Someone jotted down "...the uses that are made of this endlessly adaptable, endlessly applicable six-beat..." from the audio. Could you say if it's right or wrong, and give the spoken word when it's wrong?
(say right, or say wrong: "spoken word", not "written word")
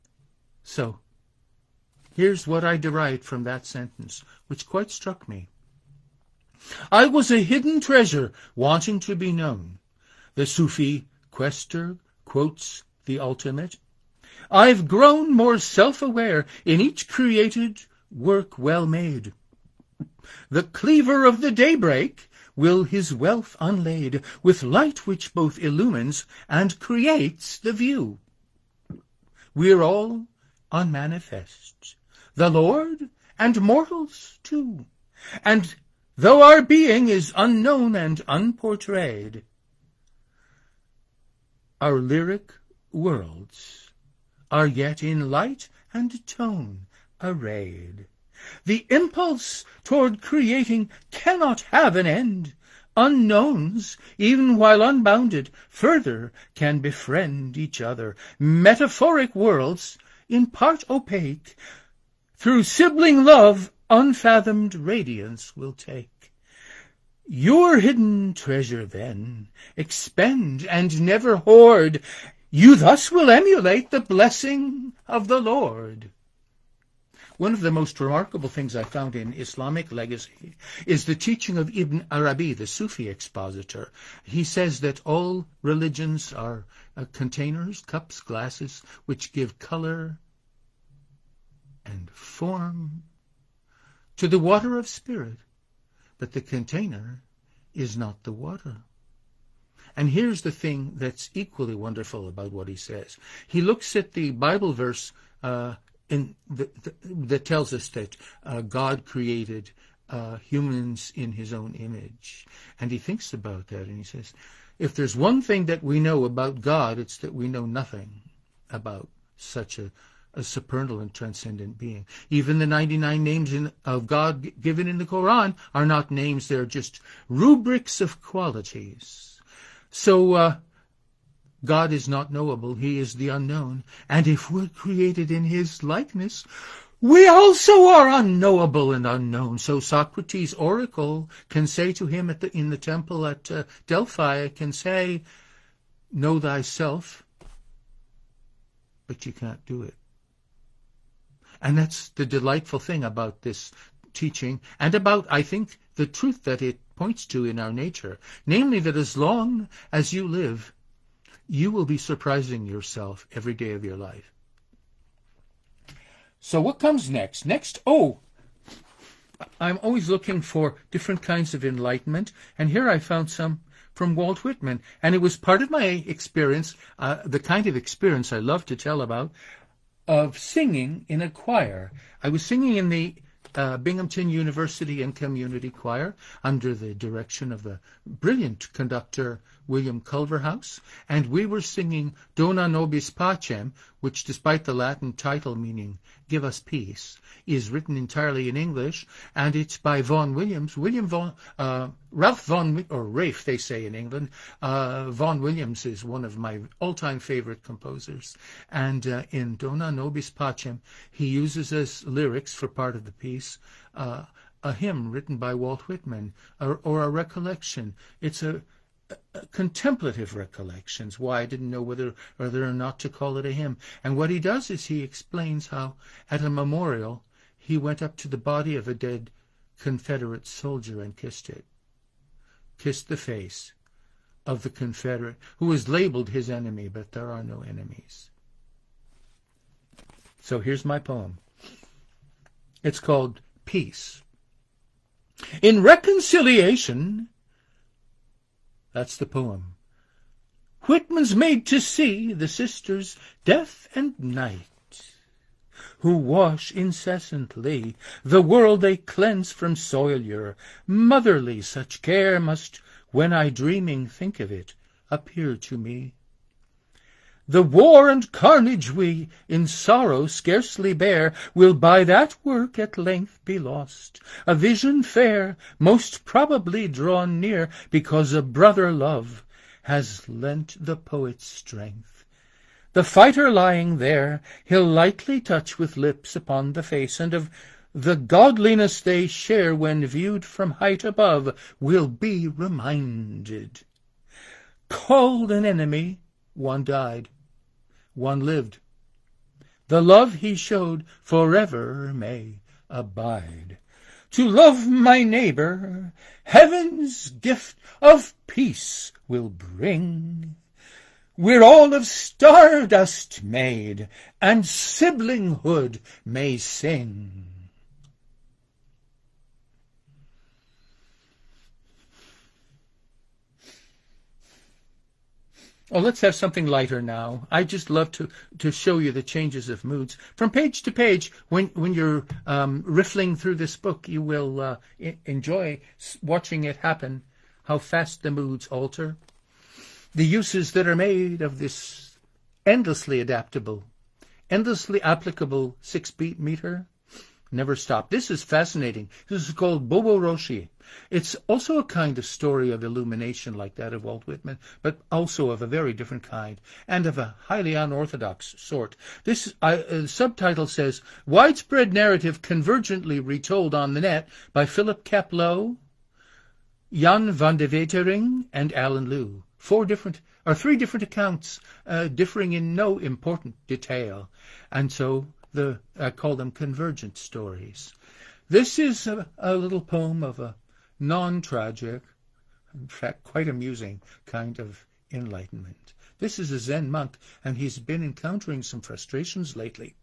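right.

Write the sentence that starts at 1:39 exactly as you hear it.
And here's the thing that's equally wonderful about what he says.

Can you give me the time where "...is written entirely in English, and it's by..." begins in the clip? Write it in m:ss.
3:17.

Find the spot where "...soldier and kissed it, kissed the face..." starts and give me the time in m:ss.
3:50.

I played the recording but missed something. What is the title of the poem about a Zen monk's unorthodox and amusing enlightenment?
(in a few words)
Bobo Roshi.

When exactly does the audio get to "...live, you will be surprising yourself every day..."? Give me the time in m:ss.
2:40.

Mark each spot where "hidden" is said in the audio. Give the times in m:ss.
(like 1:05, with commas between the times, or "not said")
0:07, 1:07.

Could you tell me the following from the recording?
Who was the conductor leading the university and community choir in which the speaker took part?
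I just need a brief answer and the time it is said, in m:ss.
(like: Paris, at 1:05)
William Culverhouse, at 3:09.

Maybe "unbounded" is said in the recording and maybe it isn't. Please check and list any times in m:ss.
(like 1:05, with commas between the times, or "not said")
0:54.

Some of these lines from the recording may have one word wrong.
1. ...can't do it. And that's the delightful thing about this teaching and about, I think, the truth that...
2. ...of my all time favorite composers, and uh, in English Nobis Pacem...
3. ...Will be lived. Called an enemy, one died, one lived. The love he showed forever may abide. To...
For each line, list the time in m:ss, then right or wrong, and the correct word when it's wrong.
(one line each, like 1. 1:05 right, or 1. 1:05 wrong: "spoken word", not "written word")
1. 2:29 right
2. 3:26 wrong: "Dona", not "English"
3. 4:51 wrong: "reminded", not "lived".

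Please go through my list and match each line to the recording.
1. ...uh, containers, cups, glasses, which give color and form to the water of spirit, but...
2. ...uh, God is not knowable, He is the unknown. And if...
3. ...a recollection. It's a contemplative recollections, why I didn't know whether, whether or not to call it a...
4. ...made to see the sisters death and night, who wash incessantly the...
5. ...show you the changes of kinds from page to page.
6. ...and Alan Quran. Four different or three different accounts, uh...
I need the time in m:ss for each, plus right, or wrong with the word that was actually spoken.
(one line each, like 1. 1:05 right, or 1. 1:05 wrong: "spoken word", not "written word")
1. 1:26 right
2. 2:10 right
3. 3:37 right
4. 4:11 right
5. 5:28 wrong: "moods", not "kinds"
6. 6:08 wrong: "Lew", not "Quran".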